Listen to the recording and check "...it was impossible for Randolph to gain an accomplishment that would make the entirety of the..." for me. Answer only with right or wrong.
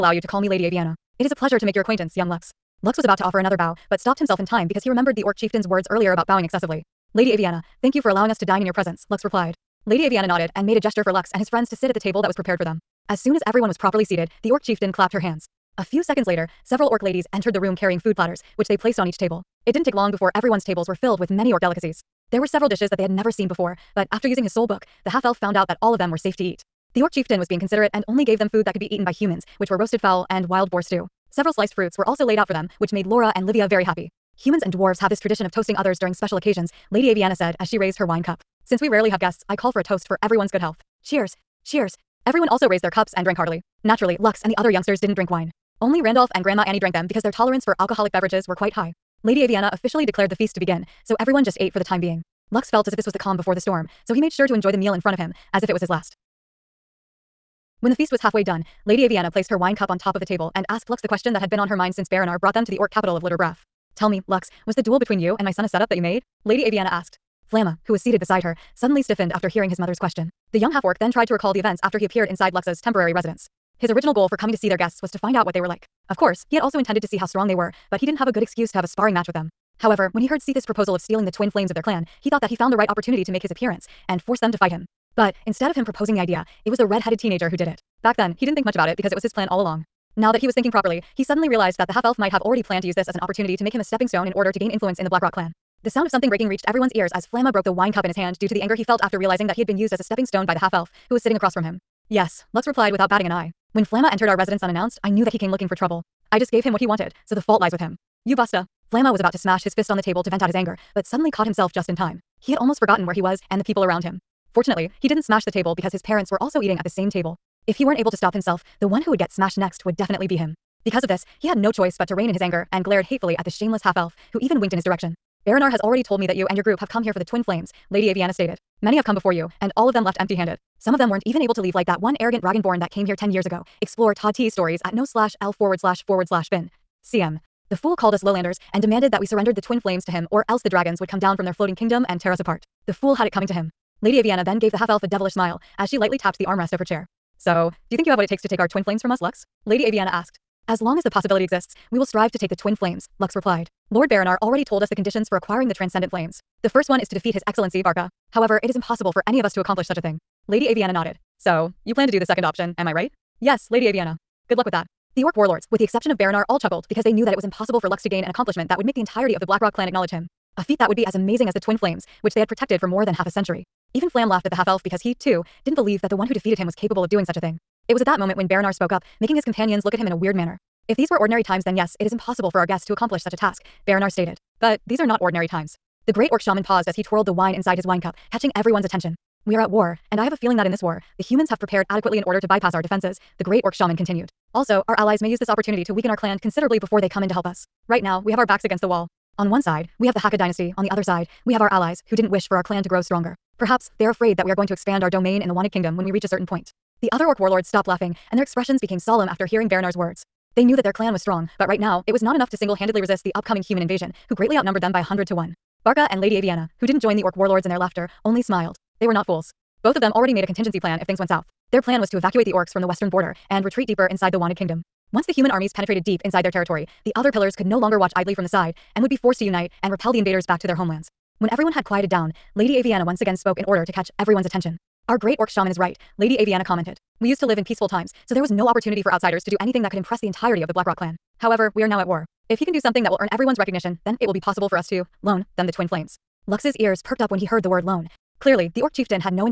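wrong.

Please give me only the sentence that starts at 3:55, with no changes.
Our great orc shaman is right, Lady Aviana commented.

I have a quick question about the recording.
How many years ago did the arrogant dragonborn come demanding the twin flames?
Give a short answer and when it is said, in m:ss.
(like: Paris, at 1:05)
10, at 2:13.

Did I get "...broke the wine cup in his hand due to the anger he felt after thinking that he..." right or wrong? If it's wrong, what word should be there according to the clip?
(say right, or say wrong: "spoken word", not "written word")
wrong: "realizing", not "thinking".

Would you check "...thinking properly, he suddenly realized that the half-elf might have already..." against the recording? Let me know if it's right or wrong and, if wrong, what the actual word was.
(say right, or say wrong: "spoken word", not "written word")
right.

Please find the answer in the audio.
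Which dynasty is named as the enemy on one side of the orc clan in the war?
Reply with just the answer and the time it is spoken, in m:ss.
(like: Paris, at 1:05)
Hakka dynasty, at 3:20.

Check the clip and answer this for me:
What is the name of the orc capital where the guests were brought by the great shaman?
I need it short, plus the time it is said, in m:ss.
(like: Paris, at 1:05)
Litterbrath, at 1:03.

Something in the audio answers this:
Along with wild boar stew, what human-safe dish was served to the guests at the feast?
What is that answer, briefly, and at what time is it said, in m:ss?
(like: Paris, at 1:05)
roasted fowl, at 0:29.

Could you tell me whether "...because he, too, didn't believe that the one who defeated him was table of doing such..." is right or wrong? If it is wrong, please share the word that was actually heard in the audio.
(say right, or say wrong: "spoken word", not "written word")
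wrong: "capable", not "table".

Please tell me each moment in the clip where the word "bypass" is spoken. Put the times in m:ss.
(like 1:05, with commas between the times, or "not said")
3:12.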